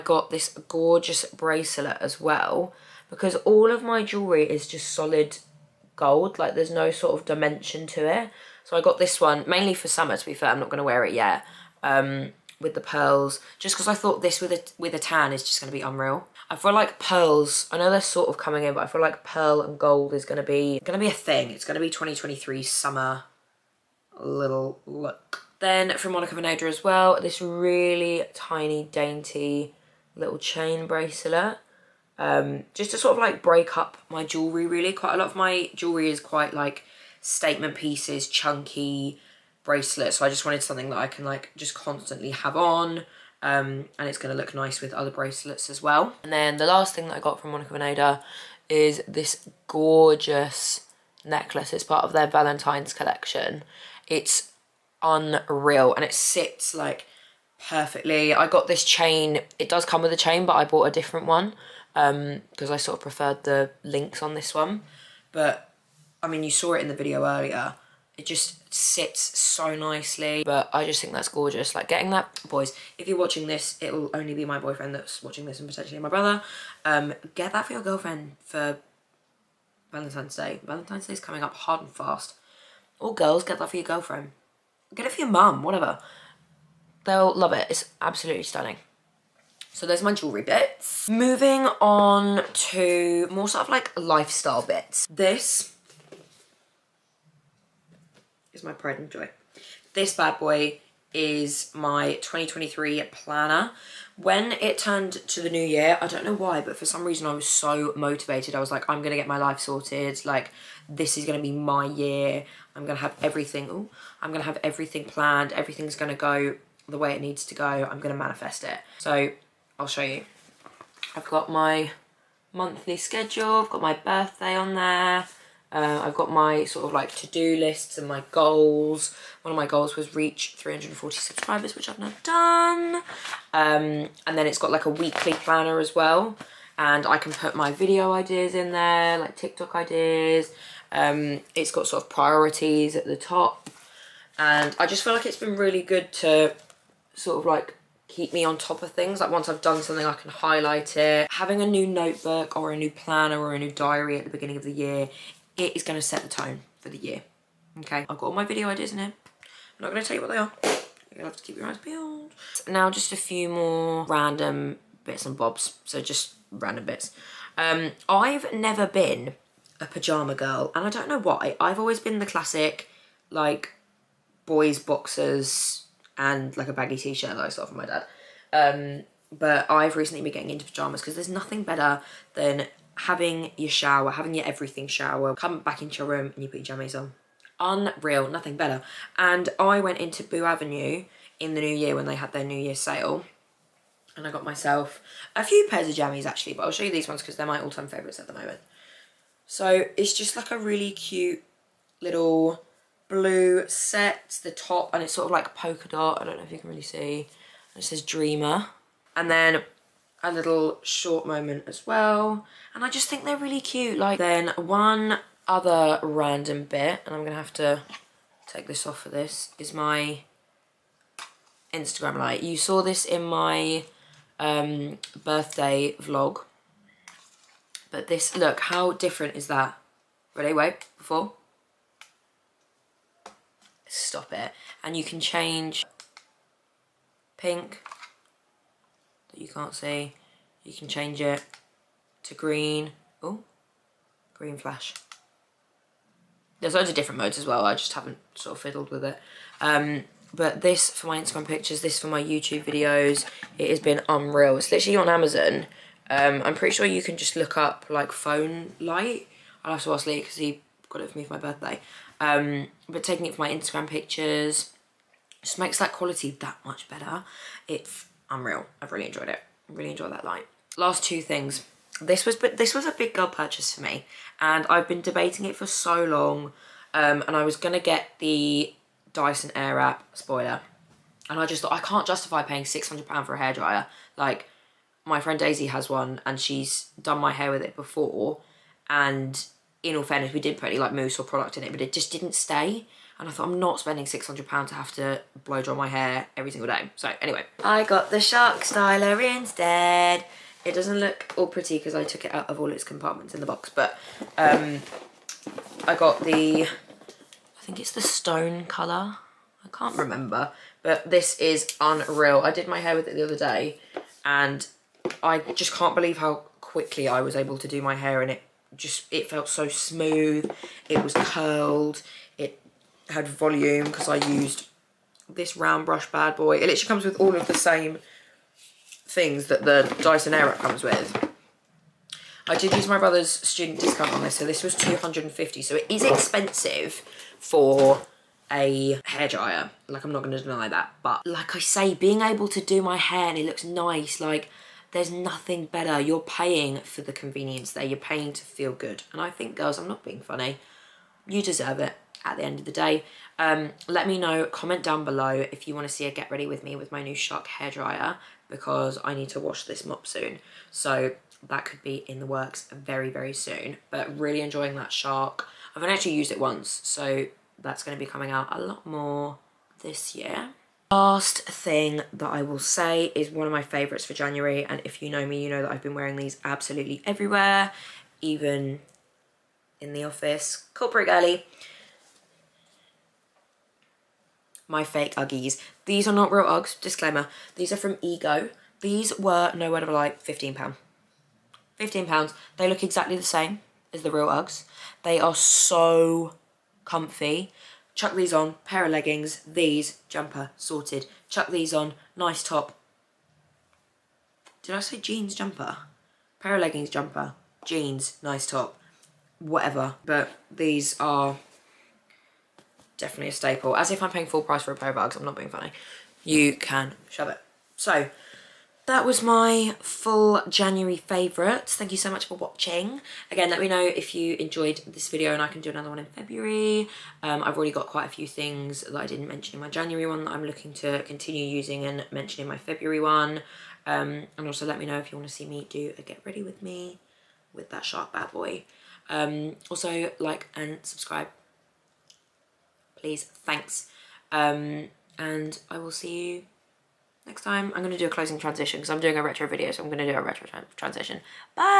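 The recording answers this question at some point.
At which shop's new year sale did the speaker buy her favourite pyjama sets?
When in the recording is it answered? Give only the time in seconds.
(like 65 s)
190 s.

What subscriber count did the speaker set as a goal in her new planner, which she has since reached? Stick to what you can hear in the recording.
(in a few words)
340.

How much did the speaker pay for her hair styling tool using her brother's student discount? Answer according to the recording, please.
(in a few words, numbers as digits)
250.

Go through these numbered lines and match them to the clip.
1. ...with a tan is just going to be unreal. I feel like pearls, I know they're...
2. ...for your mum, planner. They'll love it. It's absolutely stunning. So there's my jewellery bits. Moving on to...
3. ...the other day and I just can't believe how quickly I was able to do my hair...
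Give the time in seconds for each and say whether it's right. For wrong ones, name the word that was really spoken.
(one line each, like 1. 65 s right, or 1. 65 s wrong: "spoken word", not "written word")
1. 14 s right
2. 85 s wrong: "whatever", not "planner"
3. 313 s right.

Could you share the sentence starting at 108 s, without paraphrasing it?
I was like, I'm going to get my life sorted.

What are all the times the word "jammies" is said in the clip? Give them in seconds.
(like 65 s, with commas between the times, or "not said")
186 s, 195 s.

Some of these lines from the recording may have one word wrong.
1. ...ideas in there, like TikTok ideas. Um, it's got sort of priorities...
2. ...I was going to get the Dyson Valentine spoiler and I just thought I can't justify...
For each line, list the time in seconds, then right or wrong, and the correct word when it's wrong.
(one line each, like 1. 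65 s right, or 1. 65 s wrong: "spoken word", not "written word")
1. 138 s right
2. 277 s wrong: "Airwrap", not "Valentine".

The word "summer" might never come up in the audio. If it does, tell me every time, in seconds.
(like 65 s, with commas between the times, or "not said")
9 s, 22 s.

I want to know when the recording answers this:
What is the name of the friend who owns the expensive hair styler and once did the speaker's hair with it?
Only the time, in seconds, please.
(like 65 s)
285 s.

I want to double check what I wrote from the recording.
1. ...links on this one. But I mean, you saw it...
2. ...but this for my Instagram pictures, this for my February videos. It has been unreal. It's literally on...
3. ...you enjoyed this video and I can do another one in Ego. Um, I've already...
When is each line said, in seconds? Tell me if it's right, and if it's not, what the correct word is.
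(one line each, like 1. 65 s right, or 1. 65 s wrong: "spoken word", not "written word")
1. 63 s right
2. 250 s wrong: "YouTube", not "February"
3. 424 s wrong: "February", not "Ego".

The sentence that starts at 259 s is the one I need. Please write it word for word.
I'll have to ask Lee because he got it for me for my birthday.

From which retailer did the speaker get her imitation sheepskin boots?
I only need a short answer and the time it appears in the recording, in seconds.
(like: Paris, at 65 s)
Ego, at 388 s.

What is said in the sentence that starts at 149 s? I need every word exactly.
Like once I've done something, I can highlight it.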